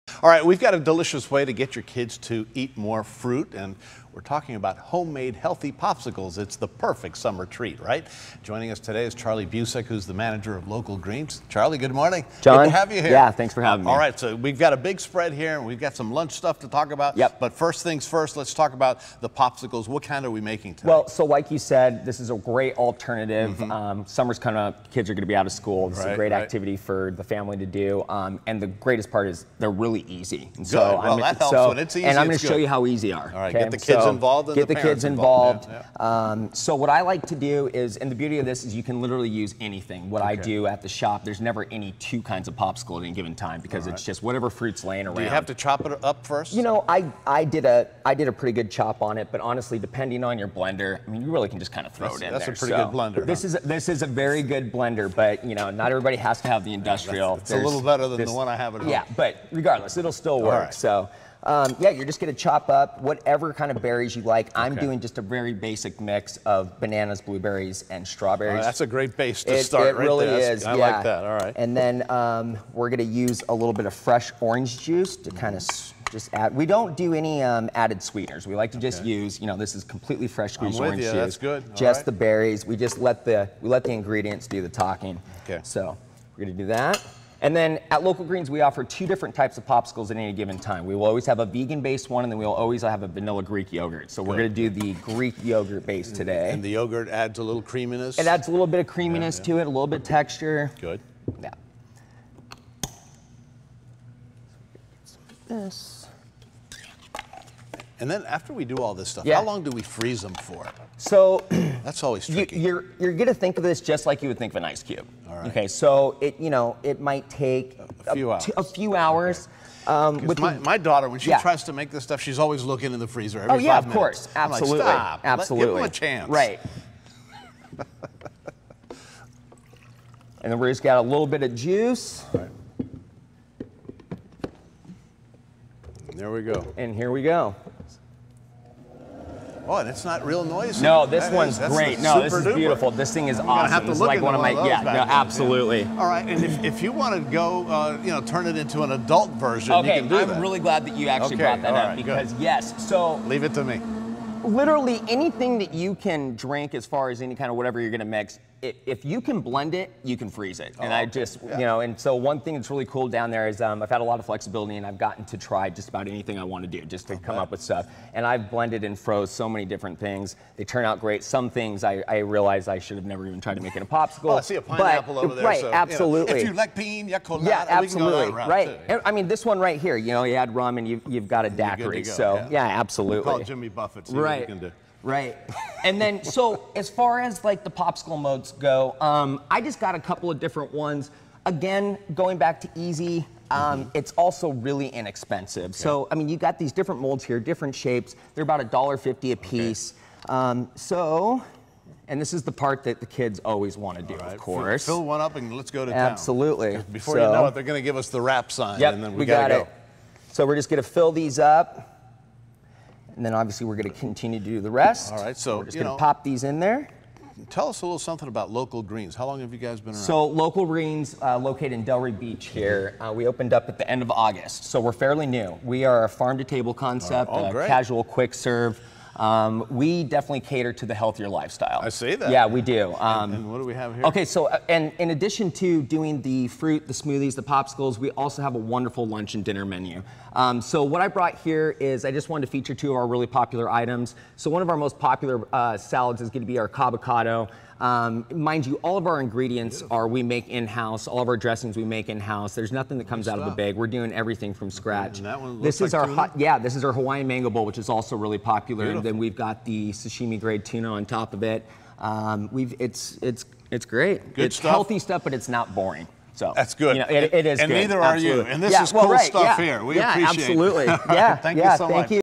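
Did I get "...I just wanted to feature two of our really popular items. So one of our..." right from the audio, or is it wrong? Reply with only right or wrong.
right.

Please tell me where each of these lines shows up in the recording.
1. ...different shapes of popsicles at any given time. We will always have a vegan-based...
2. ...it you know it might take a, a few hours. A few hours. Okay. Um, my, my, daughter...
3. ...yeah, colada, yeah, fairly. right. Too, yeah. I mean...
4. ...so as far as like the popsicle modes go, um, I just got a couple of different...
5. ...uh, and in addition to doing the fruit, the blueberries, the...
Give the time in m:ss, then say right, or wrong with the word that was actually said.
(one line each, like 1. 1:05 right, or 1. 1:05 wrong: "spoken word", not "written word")
1. 1:29 wrong: "types", not "shapes"
2. 1:56 right
3. 2:57 wrong: "absolutely", not "fairly"
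4. 3:06 right
5. 3:54 wrong: "smoothies", not "blueberries".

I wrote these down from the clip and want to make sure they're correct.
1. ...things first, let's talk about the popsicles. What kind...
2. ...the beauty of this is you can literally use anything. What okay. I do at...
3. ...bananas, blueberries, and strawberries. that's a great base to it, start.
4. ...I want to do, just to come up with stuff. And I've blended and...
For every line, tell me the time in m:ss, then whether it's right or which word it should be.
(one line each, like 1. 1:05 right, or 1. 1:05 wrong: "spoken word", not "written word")
1. 0:17 right
2. 0:38 right
3. 1:06 right
4. 2:46 right.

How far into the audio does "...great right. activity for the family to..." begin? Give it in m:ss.
0:26.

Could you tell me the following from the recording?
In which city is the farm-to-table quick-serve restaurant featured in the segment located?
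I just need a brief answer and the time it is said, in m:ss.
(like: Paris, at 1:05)
Delray Beach, at 3:41.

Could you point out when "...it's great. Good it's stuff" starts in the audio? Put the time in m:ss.
4:23.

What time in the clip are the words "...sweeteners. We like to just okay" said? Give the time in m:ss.
1:18.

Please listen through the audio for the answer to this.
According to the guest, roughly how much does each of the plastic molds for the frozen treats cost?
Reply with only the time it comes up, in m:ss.
3:18.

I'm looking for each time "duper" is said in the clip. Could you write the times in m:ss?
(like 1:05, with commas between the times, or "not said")
2:22.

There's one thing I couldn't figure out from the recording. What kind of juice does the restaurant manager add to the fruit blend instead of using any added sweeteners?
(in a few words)
fresh orange juice.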